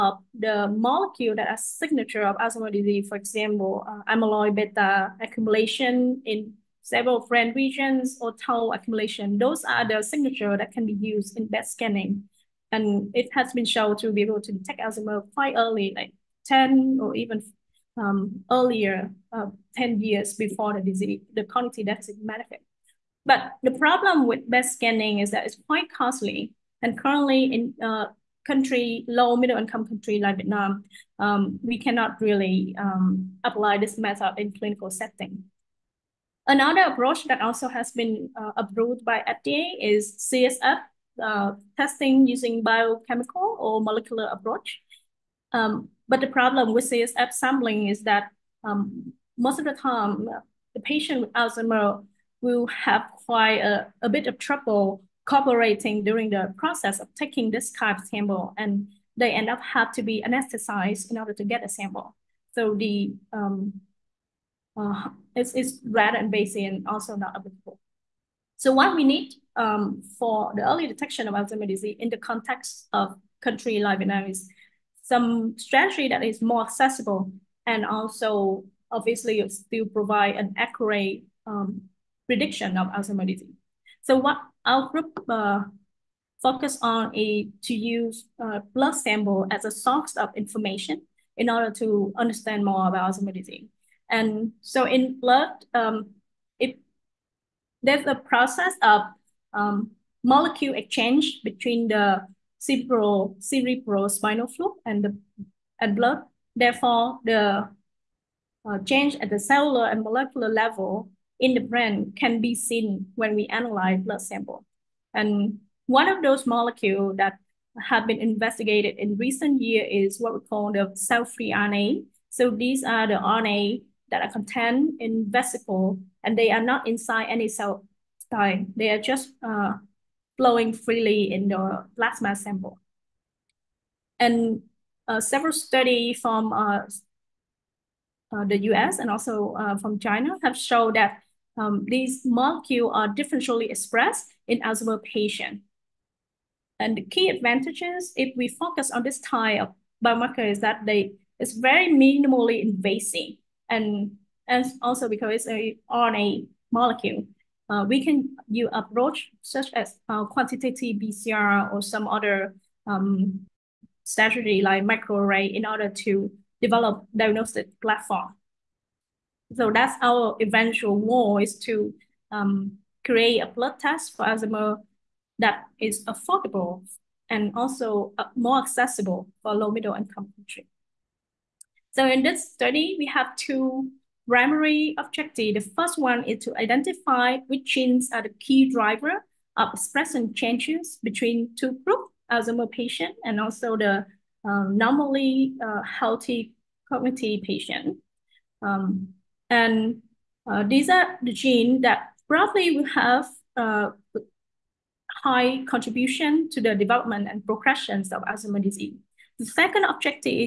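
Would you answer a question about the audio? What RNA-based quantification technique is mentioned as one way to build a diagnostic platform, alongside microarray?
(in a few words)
quantitative PCR.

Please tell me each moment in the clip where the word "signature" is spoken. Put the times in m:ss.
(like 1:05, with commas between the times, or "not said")
0:01, 0:10.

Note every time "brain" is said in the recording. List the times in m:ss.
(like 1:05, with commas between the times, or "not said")
0:07, 1:51.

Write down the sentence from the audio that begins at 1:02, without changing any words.
So the um, uh, it's, it's rather invasive and also not applicable.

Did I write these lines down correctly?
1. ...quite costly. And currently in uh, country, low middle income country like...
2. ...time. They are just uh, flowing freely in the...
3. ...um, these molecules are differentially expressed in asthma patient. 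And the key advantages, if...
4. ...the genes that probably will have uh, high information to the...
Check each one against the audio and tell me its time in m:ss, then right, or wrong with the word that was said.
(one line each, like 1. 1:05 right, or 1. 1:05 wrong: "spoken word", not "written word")
1. 0:25 right
2. 2:08 right
3. 2:21 right
4. 3:21 wrong: "contribution", not "information".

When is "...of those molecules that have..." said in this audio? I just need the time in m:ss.
1:56.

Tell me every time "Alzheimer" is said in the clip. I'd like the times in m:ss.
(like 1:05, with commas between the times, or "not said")
0:02, 0:14, 0:51, 1:11, 1:22, 1:33, 3:28.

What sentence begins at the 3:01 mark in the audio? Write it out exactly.
So in this study, we have two primary objective.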